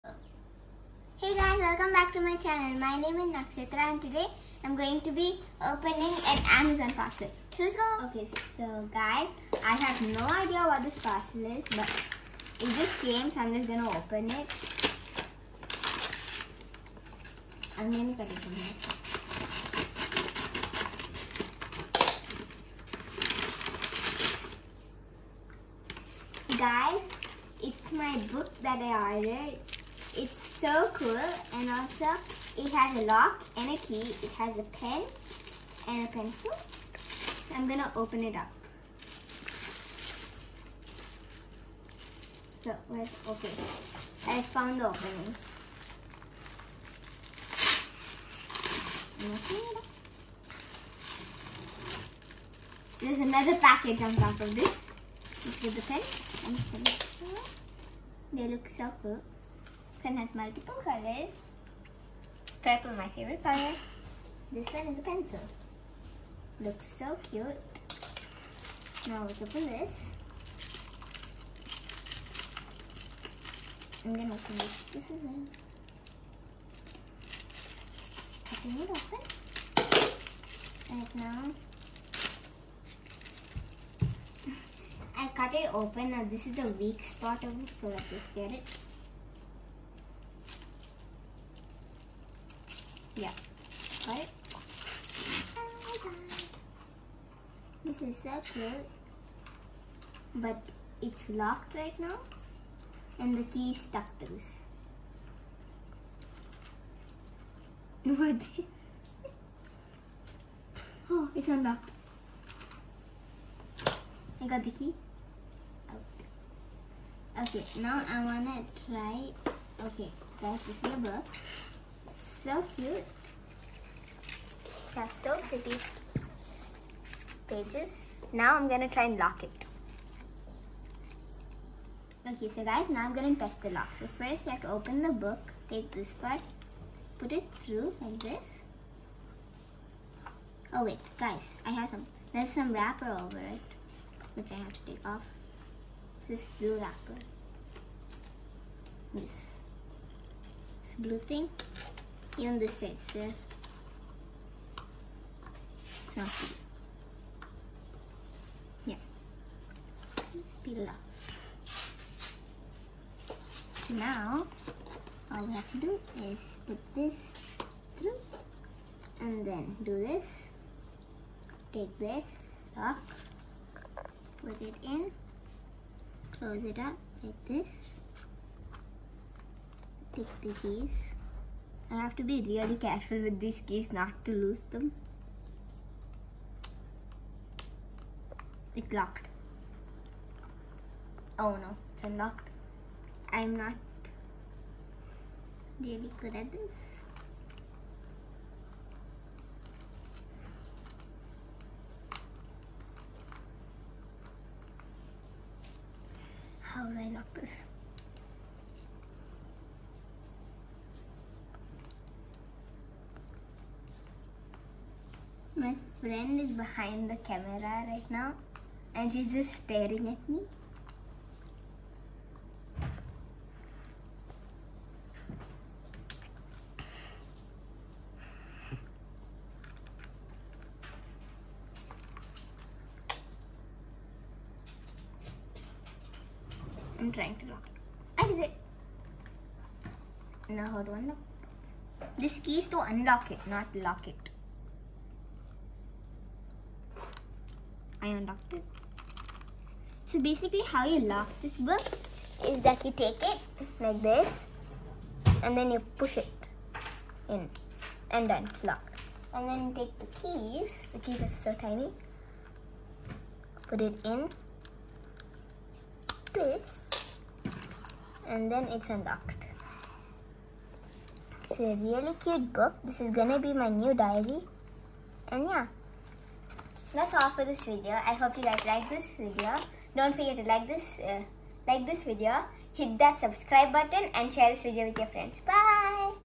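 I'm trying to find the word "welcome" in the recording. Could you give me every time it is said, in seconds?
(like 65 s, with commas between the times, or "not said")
1 s.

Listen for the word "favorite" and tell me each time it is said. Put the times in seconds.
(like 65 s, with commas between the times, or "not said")
63 s.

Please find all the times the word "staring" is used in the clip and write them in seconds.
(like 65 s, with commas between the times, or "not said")
219 s.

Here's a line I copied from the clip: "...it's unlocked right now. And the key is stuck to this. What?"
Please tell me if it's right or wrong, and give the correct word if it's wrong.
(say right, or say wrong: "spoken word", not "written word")
wrong: "locked", not "unlocked".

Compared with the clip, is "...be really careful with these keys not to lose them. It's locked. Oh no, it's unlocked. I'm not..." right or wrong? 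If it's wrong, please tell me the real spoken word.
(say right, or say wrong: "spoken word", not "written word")
right.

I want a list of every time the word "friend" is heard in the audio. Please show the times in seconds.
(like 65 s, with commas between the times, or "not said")
216 s, 285 s.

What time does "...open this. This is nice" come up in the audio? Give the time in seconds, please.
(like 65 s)
74 s.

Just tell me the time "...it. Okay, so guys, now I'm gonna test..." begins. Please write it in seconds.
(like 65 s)
129 s.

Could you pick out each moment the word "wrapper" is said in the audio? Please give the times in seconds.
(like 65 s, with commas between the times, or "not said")
142 s, 146 s.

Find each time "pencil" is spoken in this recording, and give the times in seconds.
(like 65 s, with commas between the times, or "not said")
36 s, 65 s.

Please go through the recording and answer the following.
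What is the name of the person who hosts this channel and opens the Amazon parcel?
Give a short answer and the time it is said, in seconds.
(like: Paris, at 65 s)
Nakshatra, at 3 s.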